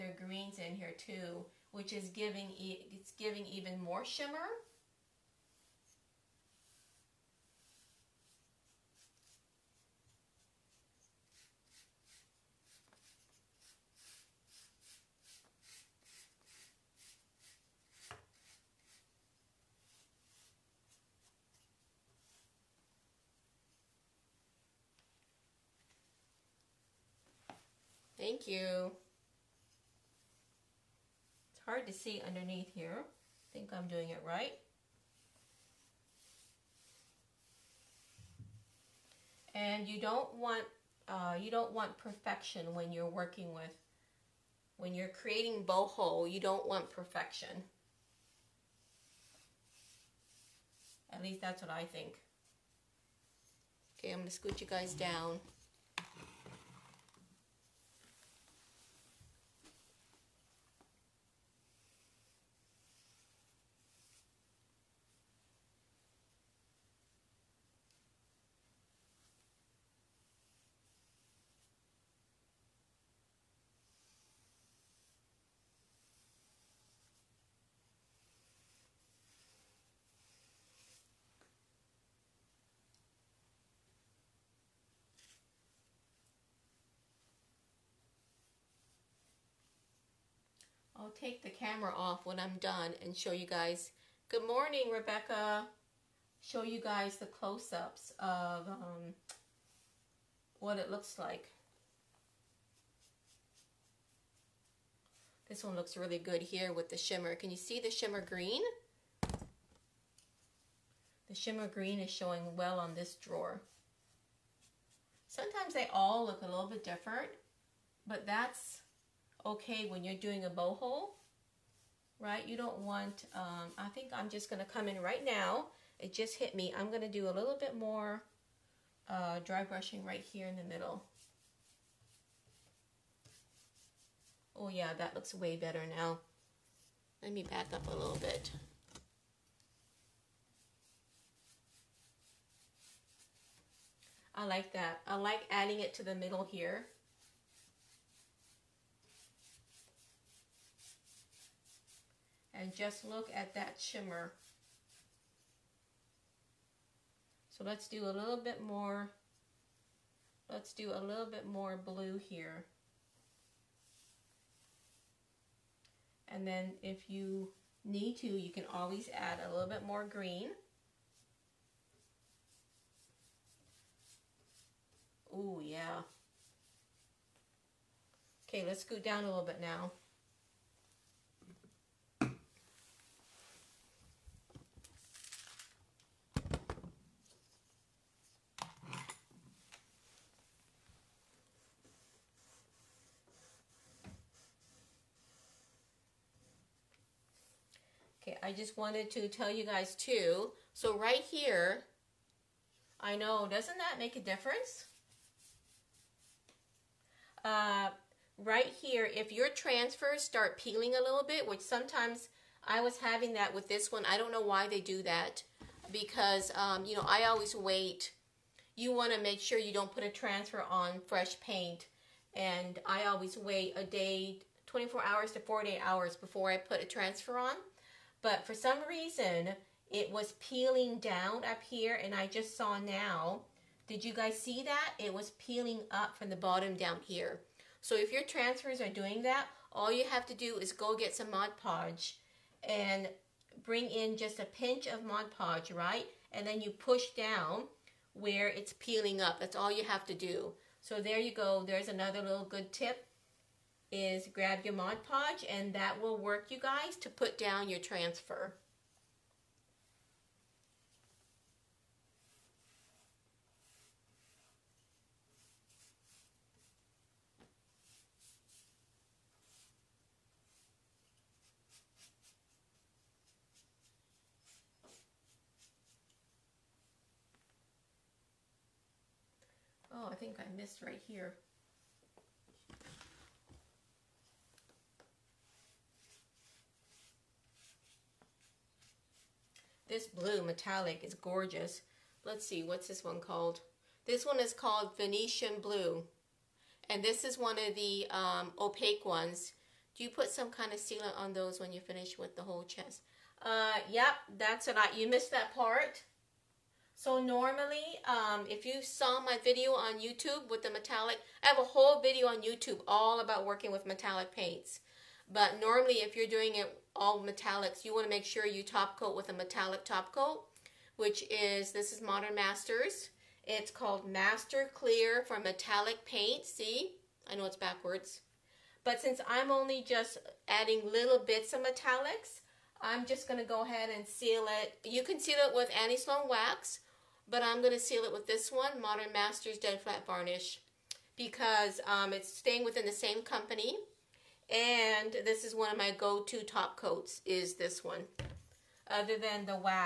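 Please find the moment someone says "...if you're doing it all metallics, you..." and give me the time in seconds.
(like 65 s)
315 s.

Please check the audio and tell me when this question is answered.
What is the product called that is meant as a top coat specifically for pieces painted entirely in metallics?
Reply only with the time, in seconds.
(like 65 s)
324 s.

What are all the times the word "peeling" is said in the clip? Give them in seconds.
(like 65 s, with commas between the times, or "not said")
210 s, 230 s, 235 s, 248 s.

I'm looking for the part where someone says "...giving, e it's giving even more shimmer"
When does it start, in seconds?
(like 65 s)
2 s.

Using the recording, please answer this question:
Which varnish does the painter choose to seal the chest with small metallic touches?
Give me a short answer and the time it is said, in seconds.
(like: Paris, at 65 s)
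Modern Masters Dead Flat Varnish, at 338 s.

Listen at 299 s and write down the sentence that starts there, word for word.
Do you put some kind of sealant on those when you finish with the whole chest?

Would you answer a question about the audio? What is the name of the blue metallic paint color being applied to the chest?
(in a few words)
Venetian Blue.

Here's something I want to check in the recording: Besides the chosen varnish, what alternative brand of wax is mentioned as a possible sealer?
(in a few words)
Annie Sloan.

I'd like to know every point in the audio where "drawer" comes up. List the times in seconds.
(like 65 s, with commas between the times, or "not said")
113 s.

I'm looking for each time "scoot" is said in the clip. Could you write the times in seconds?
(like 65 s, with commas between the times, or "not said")
54 s, 178 s.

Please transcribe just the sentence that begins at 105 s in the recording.
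This one looks really good here with the shimmer.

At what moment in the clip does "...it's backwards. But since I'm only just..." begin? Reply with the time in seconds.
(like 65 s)
327 s.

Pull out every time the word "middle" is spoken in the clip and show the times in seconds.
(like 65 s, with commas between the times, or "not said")
130 s, 146 s.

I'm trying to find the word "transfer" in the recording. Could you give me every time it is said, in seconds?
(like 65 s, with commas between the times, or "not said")
209 s, 220 s, 226 s, 238 s, 257 s.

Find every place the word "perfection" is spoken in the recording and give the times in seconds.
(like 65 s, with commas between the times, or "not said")
41 s, 46 s.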